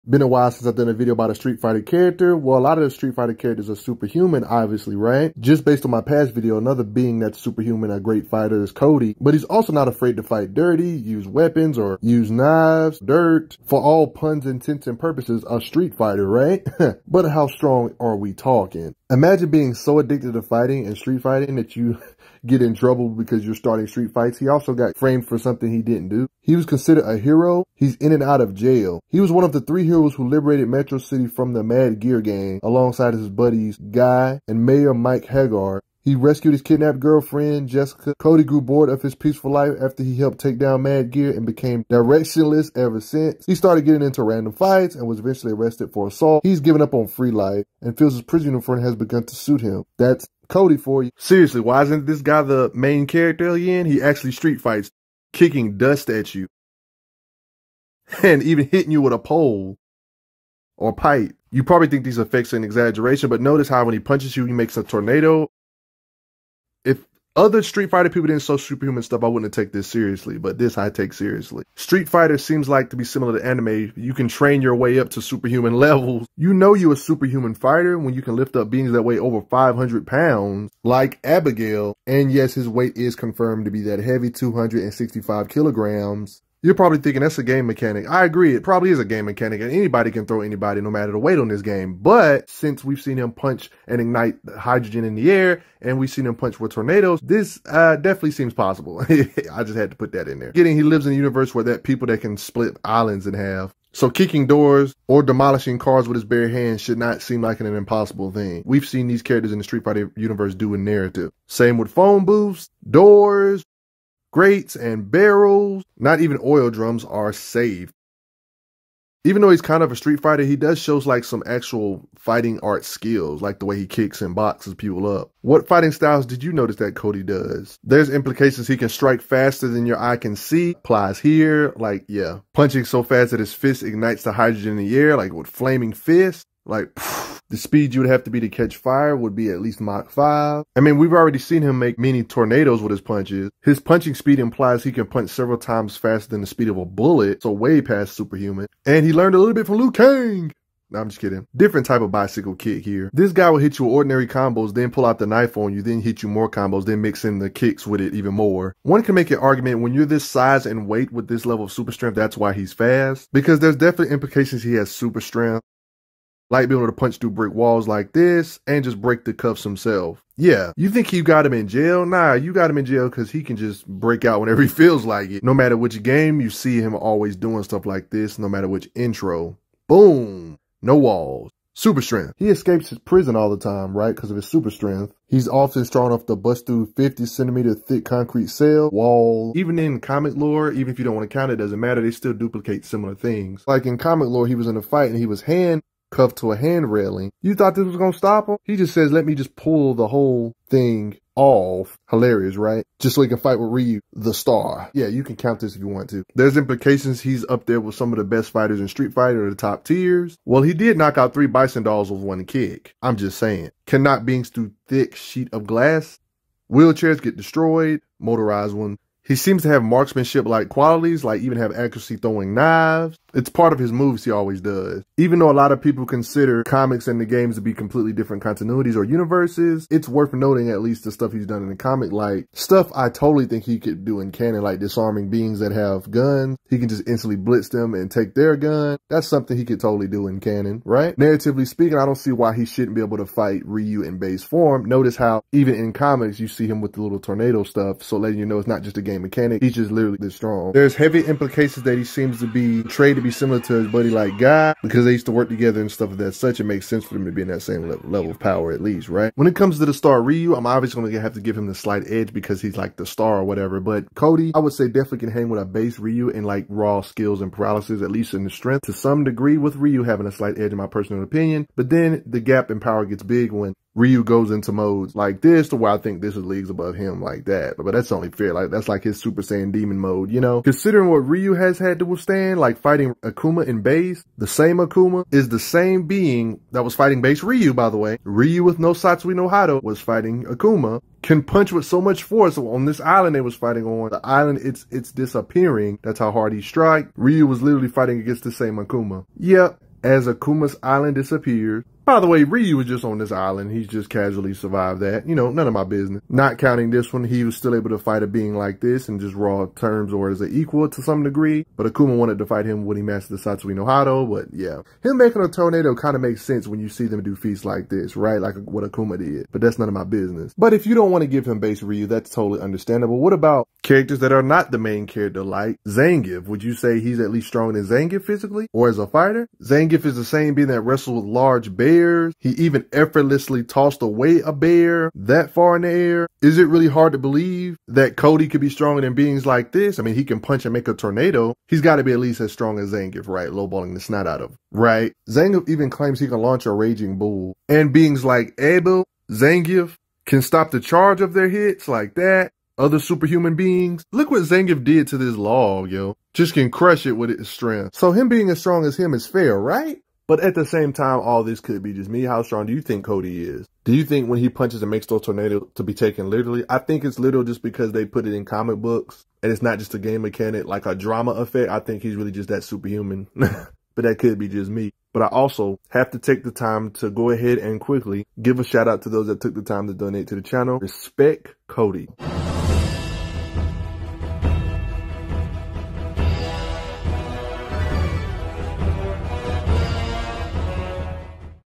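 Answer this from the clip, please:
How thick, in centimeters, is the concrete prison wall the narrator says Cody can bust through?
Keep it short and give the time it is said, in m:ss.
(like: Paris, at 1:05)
50 centimeters, at 3:06.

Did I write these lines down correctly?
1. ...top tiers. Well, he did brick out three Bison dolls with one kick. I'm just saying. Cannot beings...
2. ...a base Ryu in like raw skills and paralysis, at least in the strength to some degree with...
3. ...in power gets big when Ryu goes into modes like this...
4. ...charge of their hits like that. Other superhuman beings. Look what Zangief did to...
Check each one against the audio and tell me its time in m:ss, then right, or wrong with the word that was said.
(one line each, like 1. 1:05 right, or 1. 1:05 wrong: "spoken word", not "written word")
1. 3:29 wrong: "knock", not "brick"
2. 4:25 right
3. 4:32 right
4. 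5:50 right.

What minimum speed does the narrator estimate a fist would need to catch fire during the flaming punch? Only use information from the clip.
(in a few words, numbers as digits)
Mach 5.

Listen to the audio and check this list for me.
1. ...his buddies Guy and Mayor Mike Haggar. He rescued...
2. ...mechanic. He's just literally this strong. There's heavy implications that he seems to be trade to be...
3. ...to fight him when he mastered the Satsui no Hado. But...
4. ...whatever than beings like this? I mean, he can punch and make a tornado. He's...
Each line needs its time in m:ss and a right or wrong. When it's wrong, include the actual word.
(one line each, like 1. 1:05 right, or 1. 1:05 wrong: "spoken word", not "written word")
1. 0:33 right
2. 4:09 right
3. 5:12 right
4. 5:38 wrong: "stronger", not "whatever".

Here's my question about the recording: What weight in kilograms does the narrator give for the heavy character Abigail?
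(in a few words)
265 kilograms.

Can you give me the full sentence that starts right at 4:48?
Ryu with no Satsui no Hado was fighting Akuma can punch with so much force on this island they was fighting on.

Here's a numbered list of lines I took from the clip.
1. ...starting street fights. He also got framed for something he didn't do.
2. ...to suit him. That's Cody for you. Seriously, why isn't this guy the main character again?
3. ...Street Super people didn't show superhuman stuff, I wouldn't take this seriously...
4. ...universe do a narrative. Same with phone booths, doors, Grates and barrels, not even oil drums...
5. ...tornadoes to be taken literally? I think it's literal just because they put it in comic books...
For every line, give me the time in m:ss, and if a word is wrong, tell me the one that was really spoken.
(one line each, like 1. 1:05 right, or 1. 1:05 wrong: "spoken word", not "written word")
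1. 0:23 right
2. 0:49 right
3. 1:07 wrong: "Fighter", not "Super"
4. 1:50 right
5. 6:05 right.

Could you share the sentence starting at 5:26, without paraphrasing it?
Would you say he's at least stronger than Zangief physically or as a fighter?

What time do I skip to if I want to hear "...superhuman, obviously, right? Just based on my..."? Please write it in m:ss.
0:03.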